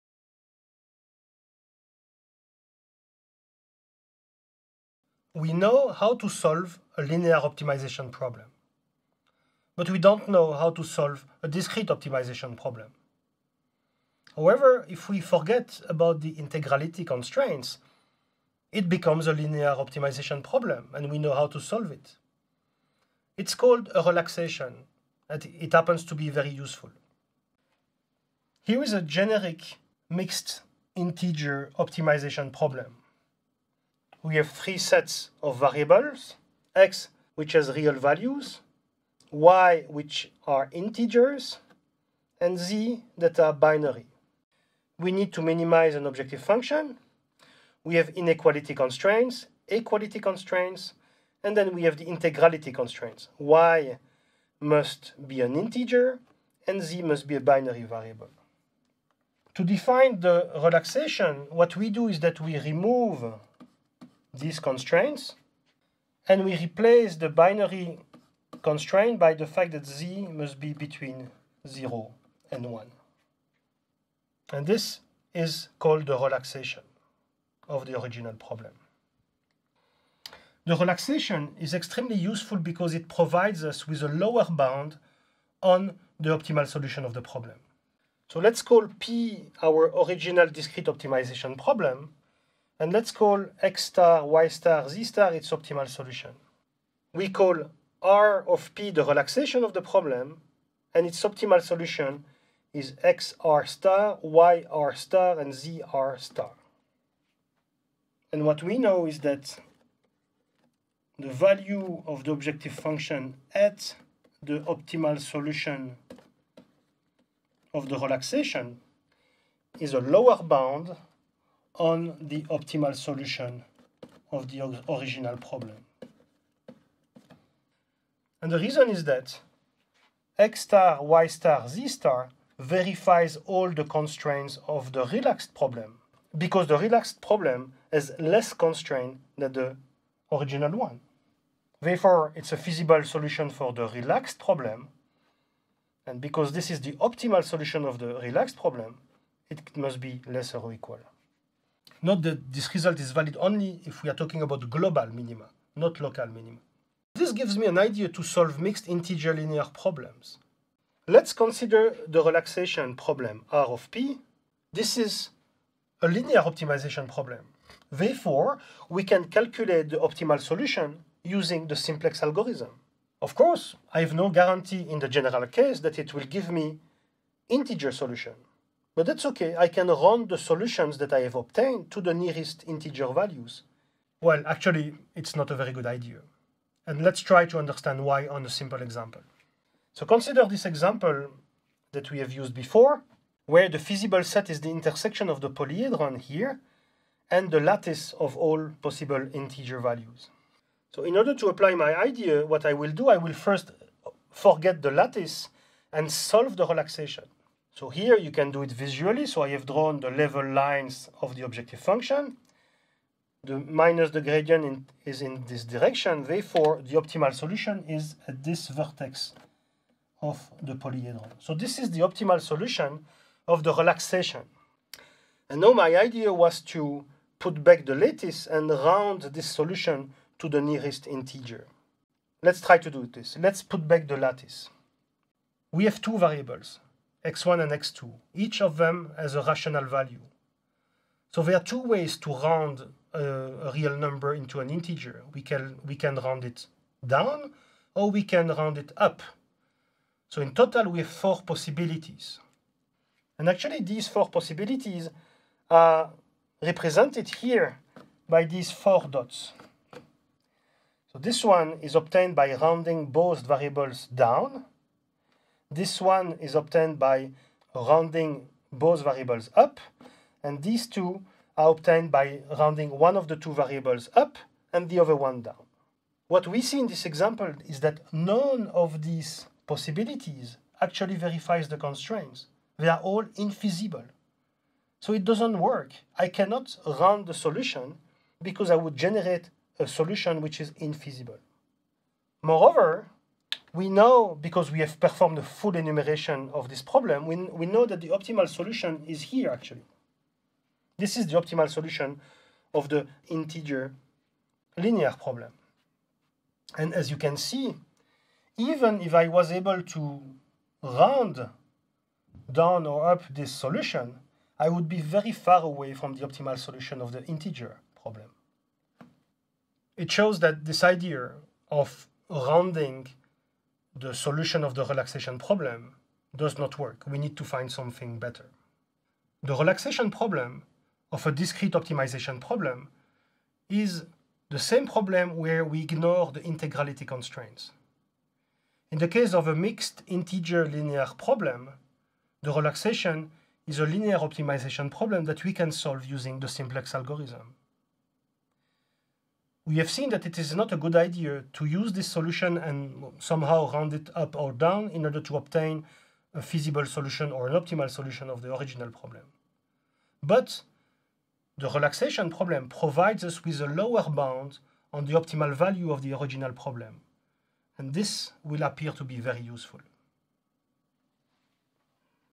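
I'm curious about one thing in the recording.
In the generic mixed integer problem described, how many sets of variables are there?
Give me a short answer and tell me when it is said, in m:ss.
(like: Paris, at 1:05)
3, at 0:34.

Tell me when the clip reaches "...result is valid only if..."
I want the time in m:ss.
2:32.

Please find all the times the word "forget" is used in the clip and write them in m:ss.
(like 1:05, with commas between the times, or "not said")
0:15, 3:24.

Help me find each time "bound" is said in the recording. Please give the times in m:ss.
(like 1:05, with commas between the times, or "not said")
1:24, 2:00, 6:04.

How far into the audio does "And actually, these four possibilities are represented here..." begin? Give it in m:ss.
4:13.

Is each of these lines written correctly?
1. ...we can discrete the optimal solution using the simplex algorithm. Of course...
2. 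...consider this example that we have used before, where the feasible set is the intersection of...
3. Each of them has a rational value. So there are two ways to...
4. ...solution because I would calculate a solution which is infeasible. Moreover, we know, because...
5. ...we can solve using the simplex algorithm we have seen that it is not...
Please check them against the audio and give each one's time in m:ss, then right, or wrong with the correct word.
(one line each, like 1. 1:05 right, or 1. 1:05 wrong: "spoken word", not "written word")
1. 2:48 wrong: "calculate", not "discrete"
2. 3:10 right
3. 3:58 right
4. 4:47 wrong: "generate", not "calculate"
5. 5:45 right.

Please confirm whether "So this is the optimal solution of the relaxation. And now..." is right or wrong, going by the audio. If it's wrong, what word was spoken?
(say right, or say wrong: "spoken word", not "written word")
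right.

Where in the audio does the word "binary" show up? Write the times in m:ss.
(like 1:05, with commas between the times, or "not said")
0:43, 0:57, 1:07.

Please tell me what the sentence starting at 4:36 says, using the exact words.
What we see in this example is that none of these possibilities actually verifies the constraints.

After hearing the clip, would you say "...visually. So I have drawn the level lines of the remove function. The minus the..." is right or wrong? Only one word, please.
wrong.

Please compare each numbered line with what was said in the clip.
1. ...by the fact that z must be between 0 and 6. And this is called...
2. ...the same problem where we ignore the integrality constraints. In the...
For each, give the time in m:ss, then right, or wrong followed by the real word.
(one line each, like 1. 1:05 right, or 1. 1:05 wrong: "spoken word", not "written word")
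1. 1:09 wrong: "1", not "6"
2. 5:34 right.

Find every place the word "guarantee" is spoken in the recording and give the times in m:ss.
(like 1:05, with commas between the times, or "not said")
2:54.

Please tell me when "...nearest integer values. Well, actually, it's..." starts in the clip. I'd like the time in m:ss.
3:02.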